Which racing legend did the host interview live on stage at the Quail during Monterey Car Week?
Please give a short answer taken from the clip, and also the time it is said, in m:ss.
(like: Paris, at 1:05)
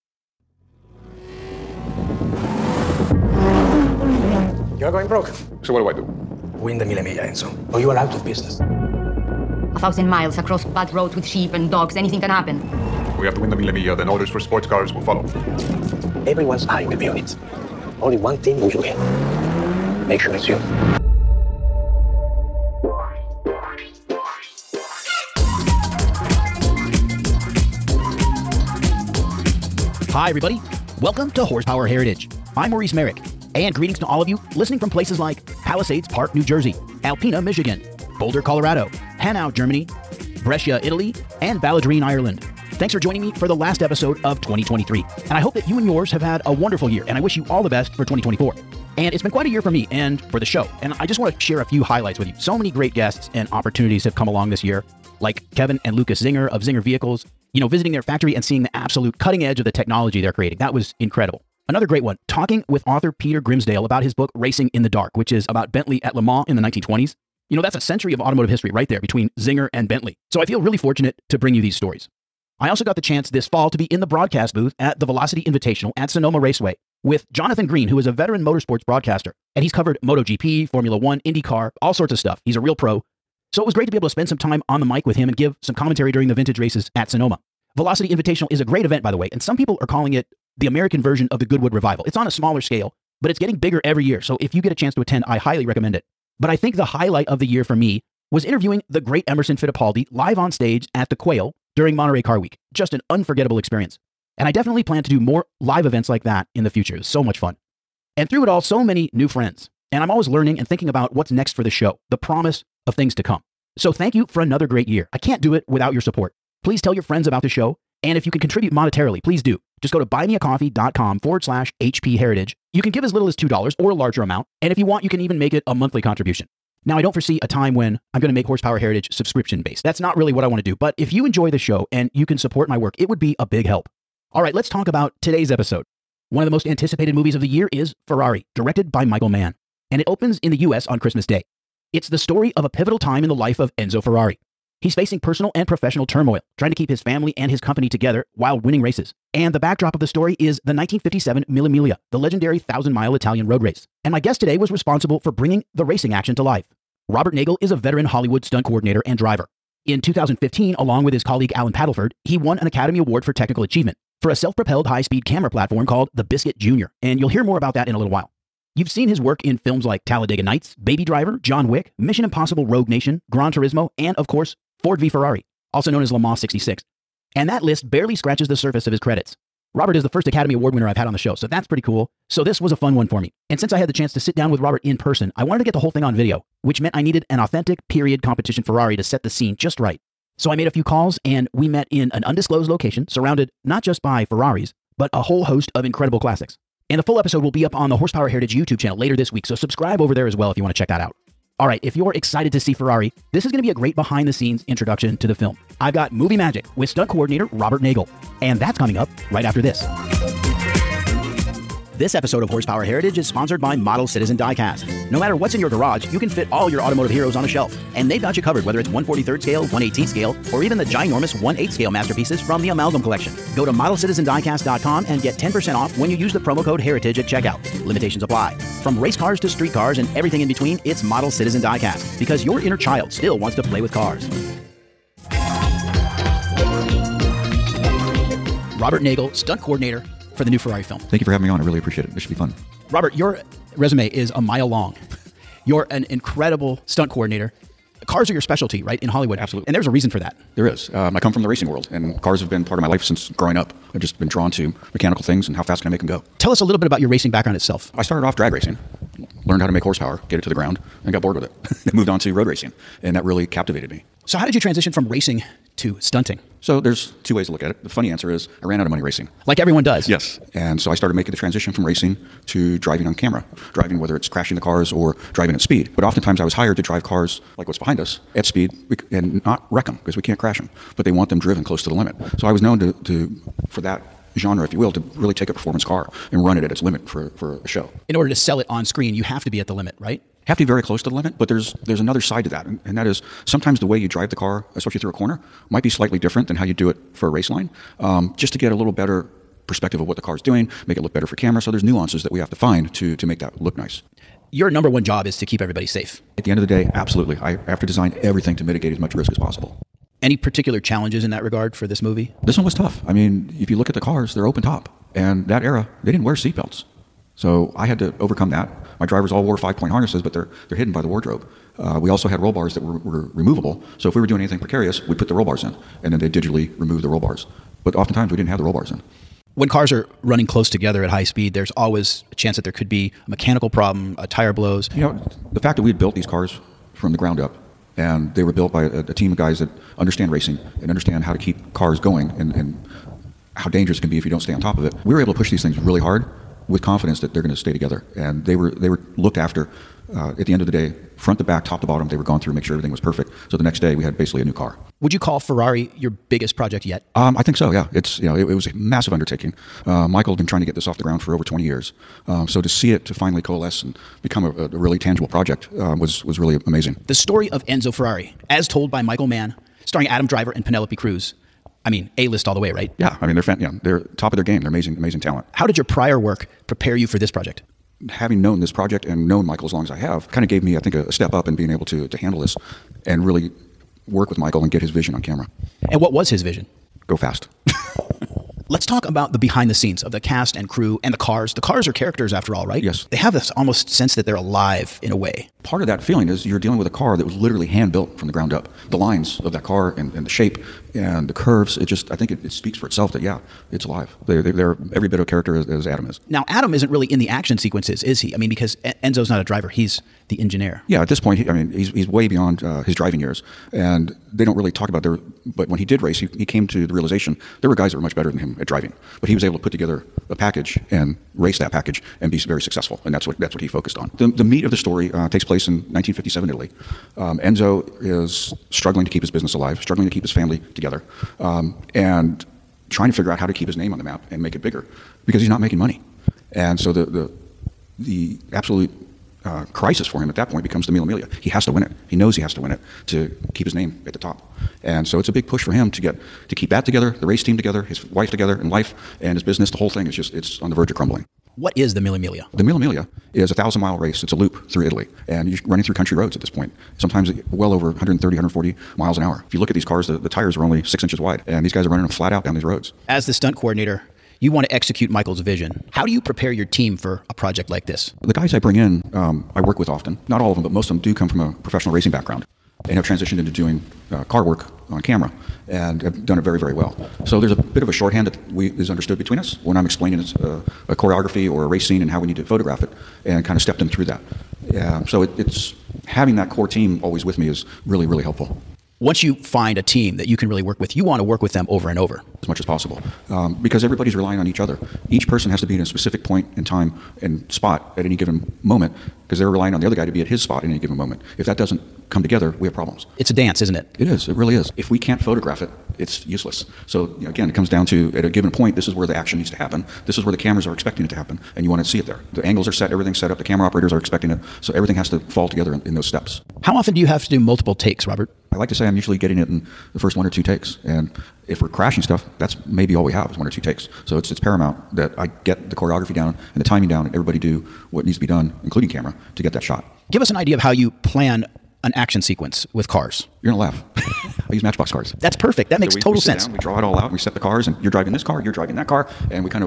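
Emerson Fittipaldi, at 1:39.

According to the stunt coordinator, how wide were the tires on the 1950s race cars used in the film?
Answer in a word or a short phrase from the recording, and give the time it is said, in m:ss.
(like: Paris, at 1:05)
6 inches, at 7:40.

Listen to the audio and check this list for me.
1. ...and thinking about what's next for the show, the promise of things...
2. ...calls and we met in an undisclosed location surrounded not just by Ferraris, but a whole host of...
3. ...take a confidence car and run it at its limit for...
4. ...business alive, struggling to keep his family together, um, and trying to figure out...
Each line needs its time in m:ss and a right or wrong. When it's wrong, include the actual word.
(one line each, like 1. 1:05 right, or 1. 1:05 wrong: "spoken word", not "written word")
1. 1:50 right
2. 3:10 right
3. 4:45 wrong: "performance", not "confidence"
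4. 7:09 right.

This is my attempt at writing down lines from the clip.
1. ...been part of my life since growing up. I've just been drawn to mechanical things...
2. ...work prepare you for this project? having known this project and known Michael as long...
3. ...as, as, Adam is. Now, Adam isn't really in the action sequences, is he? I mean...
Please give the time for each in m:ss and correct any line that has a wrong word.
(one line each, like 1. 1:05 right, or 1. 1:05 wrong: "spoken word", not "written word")
1. 4:12 right
2. 6:16 right
3. 6:45 right.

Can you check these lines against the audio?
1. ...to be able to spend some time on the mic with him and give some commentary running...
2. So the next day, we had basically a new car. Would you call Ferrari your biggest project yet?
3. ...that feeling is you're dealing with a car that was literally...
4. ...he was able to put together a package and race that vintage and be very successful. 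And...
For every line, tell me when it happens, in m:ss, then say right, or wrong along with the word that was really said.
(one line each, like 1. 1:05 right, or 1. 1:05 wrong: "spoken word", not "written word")
1. 1:23 wrong: "during", not "running"
2. 5:53 right
3. 6:35 right
4. 6:59 wrong: "package", not "vintage".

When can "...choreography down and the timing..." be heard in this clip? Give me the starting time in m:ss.
8:45.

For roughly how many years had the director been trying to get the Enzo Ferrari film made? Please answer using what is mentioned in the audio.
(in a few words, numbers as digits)
Over 20 years.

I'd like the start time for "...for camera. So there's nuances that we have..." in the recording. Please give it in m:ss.
5:01.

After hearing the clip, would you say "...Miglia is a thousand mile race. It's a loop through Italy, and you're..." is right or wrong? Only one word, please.
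right.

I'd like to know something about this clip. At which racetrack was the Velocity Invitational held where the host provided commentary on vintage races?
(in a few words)
Sonoma Raceway.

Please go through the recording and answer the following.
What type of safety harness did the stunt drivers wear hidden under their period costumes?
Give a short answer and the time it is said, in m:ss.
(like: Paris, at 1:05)
Five point harnesses, at 5:19.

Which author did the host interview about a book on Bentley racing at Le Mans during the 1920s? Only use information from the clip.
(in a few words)
Peter Grimsdale.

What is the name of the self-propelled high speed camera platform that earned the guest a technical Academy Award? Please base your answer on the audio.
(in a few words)
Biscuit Junior.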